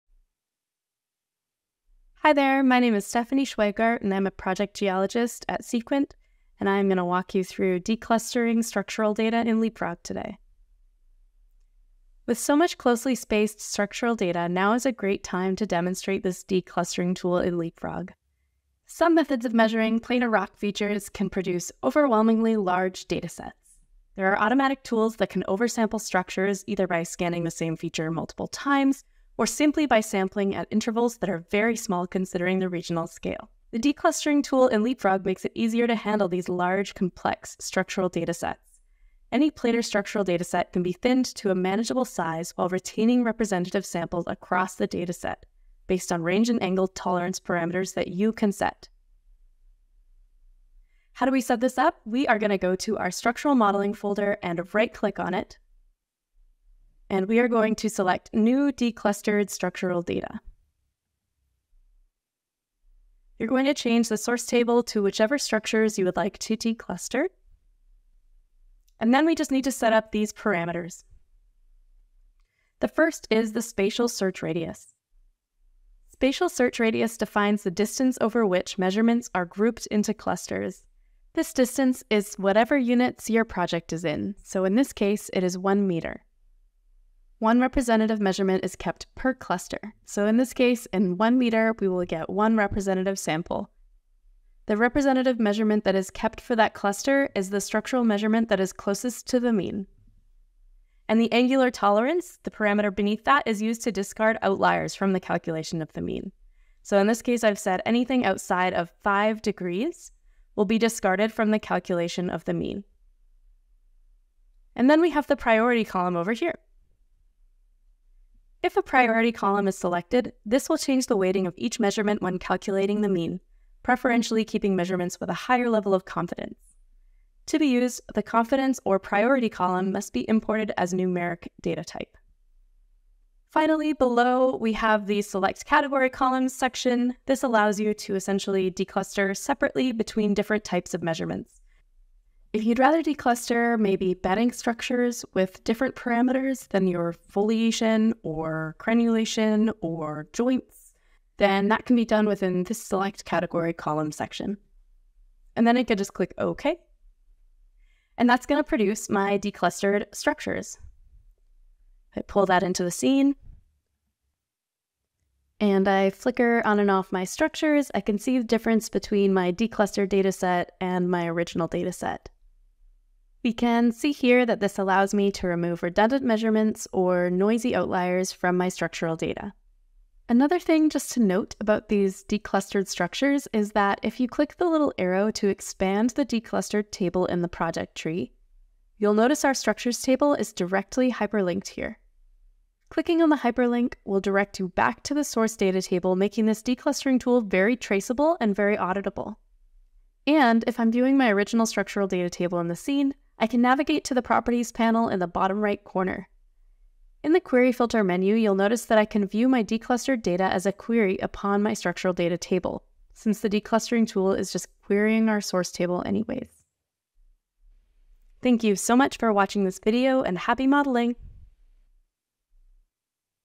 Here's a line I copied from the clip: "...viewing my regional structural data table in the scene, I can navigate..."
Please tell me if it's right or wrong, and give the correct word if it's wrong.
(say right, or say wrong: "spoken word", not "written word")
wrong: "original", not "regional".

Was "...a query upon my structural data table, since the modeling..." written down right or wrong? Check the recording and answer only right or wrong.
wrong.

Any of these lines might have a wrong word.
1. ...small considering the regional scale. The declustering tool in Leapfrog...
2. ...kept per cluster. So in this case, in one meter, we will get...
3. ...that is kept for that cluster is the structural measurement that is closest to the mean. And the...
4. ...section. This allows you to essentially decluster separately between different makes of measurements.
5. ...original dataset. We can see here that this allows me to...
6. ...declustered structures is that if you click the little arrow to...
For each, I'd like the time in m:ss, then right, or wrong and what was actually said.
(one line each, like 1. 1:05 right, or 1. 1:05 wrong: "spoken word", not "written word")
1. 0:31 right
2. 1:28 right
3. 1:35 right
4. 2:16 wrong: "types", not "makes"
5. 2:51 right
6. 3:02 right.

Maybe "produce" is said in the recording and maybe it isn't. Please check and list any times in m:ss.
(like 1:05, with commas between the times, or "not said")
0:21, 2:38.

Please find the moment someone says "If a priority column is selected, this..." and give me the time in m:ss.
1:58.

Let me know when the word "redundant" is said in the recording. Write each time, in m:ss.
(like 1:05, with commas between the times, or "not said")
2:55.